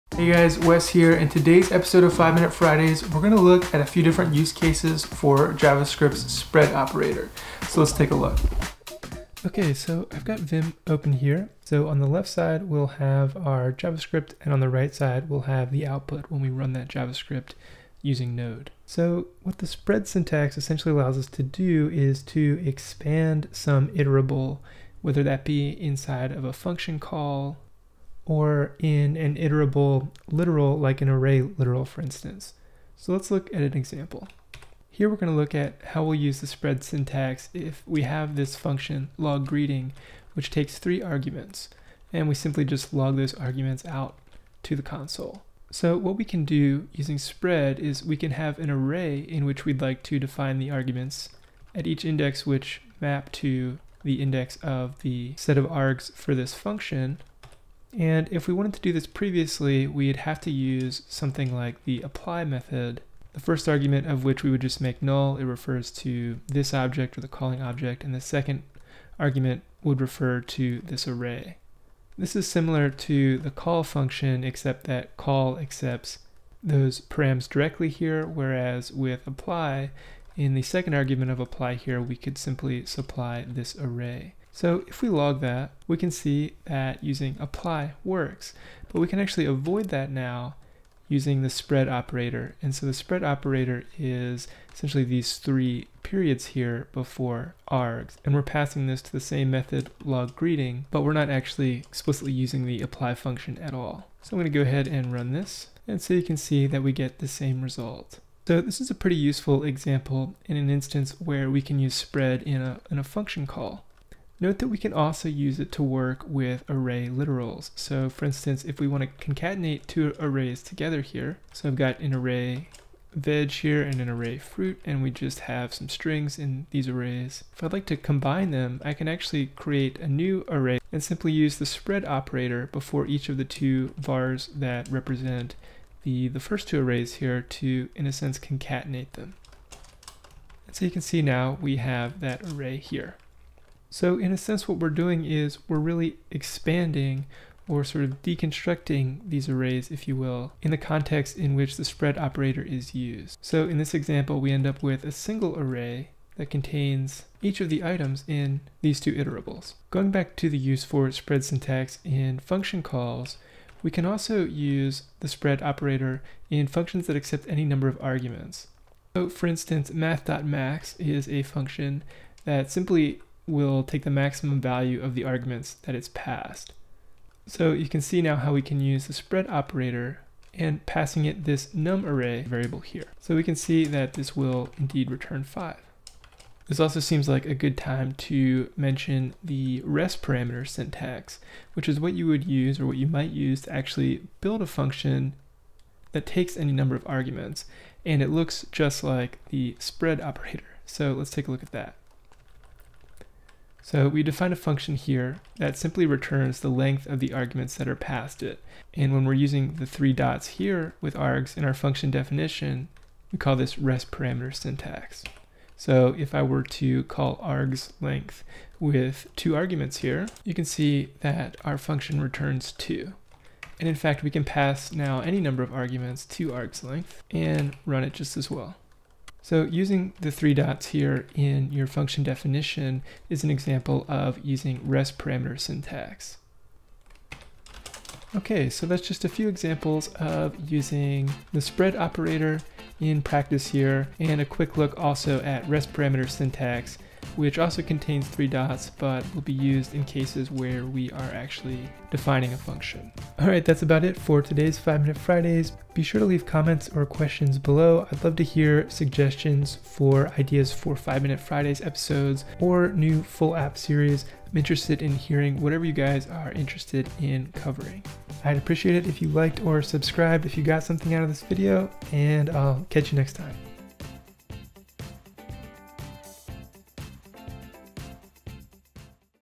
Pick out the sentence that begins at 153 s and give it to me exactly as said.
So in this example, we end up with a single array that contains each of the items in these two iterables.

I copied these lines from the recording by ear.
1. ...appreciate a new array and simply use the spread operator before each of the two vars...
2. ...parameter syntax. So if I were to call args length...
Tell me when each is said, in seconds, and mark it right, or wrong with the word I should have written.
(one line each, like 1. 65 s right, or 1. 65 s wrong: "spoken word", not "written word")
1. 129 s wrong: "create", not "appreciate"
2. 214 s right.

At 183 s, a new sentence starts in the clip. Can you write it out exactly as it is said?
So we can see that this will indeed return 5.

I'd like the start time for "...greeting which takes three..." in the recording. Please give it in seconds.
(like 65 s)
39 s.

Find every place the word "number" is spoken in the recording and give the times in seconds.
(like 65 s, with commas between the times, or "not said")
167 s, 196 s, 225 s.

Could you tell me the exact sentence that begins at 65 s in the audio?
It refers to this object or the calling object, and the second argument would refer to this array.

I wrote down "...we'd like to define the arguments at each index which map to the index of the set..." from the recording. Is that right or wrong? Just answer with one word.
right.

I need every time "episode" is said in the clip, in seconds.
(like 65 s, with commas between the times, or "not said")
1 s, 261 s.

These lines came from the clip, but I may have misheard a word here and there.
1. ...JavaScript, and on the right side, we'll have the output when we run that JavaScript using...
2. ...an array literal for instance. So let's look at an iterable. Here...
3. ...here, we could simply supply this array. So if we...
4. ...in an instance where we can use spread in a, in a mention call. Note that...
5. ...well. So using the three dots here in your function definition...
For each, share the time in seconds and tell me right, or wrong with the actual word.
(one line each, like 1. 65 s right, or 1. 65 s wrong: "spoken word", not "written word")
1. 13 s right
2. 31 s wrong: "example", not "iterable"
3. 81 s right
4. 110 s wrong: "function", not "mention"
5. 228 s right.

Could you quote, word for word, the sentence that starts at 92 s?
And so the spread operator is essentially these three periods here before args.